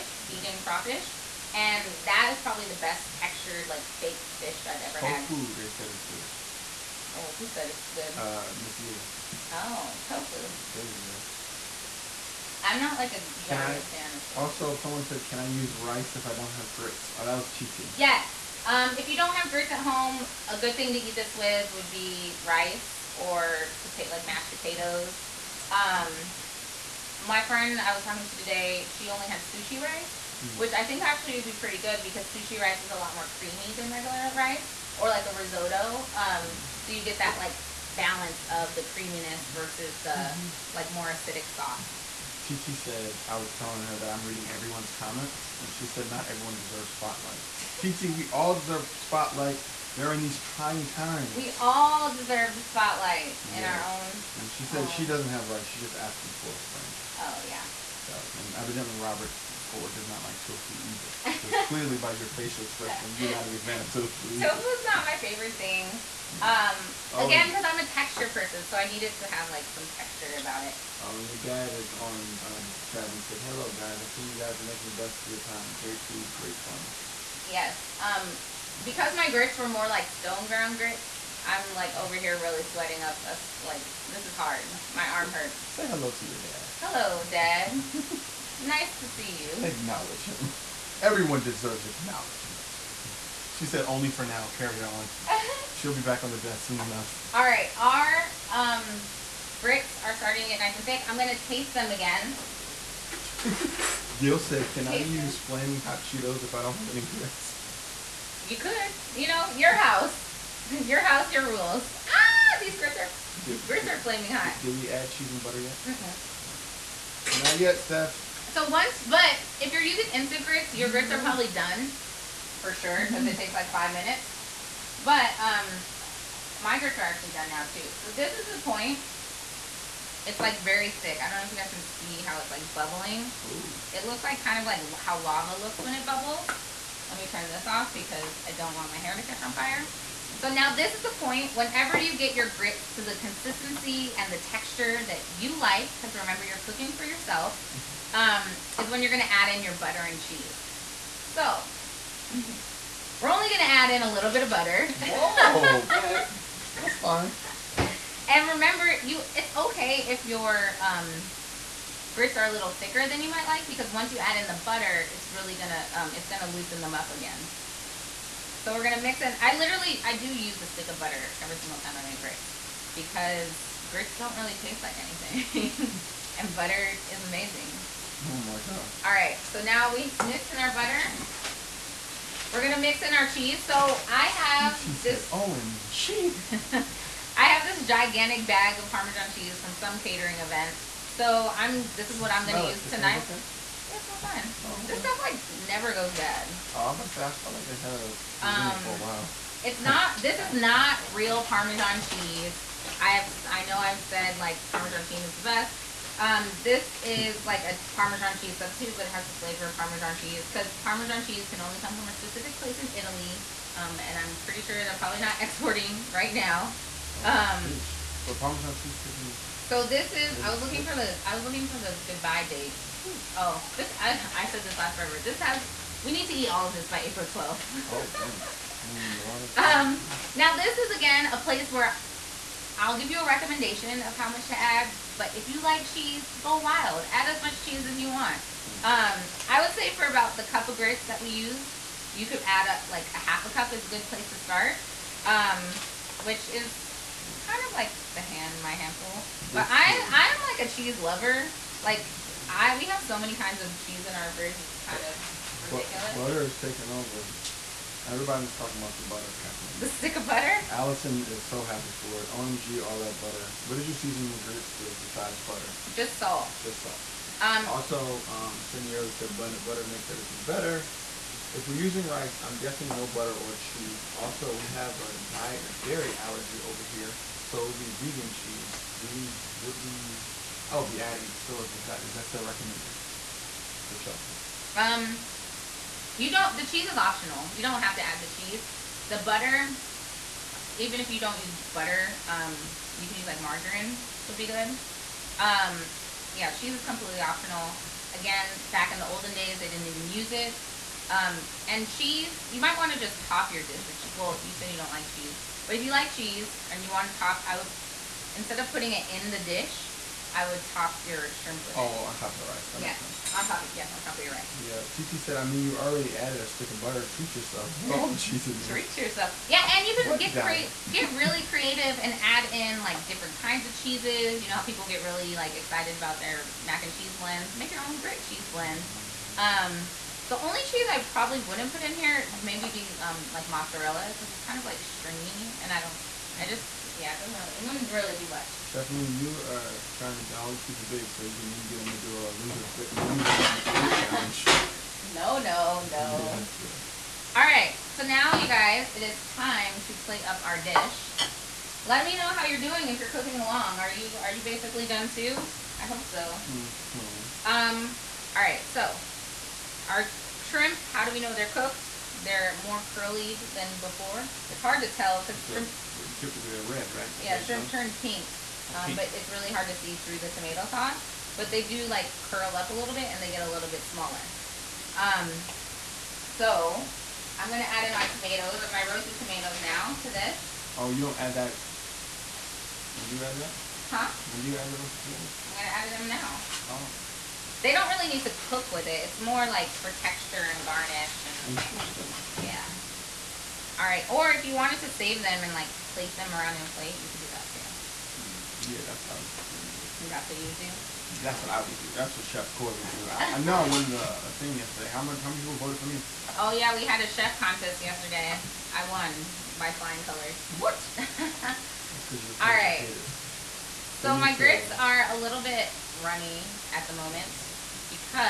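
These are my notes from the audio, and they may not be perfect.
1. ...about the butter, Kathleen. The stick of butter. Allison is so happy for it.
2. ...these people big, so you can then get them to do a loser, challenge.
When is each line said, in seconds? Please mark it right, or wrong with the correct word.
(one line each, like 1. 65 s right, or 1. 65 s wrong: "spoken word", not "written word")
1. 258 s right
2. 340 s right.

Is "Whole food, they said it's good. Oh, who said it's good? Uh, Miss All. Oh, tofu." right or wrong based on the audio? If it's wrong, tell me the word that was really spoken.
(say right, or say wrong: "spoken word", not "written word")
wrong: "Leah", not "All".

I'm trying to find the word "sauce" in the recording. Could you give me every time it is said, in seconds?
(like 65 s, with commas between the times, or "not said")
41 s, 370 s.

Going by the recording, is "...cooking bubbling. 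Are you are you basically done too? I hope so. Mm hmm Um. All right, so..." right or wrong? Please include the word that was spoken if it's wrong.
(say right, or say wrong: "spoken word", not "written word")
wrong: "along", not "bubbling".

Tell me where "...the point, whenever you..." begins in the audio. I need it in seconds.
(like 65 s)
141 s.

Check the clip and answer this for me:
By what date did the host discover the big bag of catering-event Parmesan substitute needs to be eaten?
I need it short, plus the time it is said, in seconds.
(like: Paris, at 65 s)
April 12th, at 227 s.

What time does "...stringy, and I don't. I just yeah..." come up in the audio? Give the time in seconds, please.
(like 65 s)
334 s.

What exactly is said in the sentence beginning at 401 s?
That's what Chef Corey would do.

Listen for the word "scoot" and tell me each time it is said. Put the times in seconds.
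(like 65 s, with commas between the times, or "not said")
not said.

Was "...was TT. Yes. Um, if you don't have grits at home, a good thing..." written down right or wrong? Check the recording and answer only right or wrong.
right.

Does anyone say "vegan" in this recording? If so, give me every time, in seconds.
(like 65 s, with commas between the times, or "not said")
0 s, 277 s.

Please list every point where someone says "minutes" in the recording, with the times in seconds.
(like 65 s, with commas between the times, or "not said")
123 s.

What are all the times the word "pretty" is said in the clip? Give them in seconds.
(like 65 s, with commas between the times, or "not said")
31 s, 214 s.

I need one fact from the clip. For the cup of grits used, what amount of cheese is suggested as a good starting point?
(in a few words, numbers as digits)
half a cup.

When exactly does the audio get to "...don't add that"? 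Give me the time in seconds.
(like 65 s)
381 s.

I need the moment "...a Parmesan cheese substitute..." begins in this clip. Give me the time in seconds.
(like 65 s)
207 s.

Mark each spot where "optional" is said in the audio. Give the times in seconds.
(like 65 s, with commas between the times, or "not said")
286 s, 297 s.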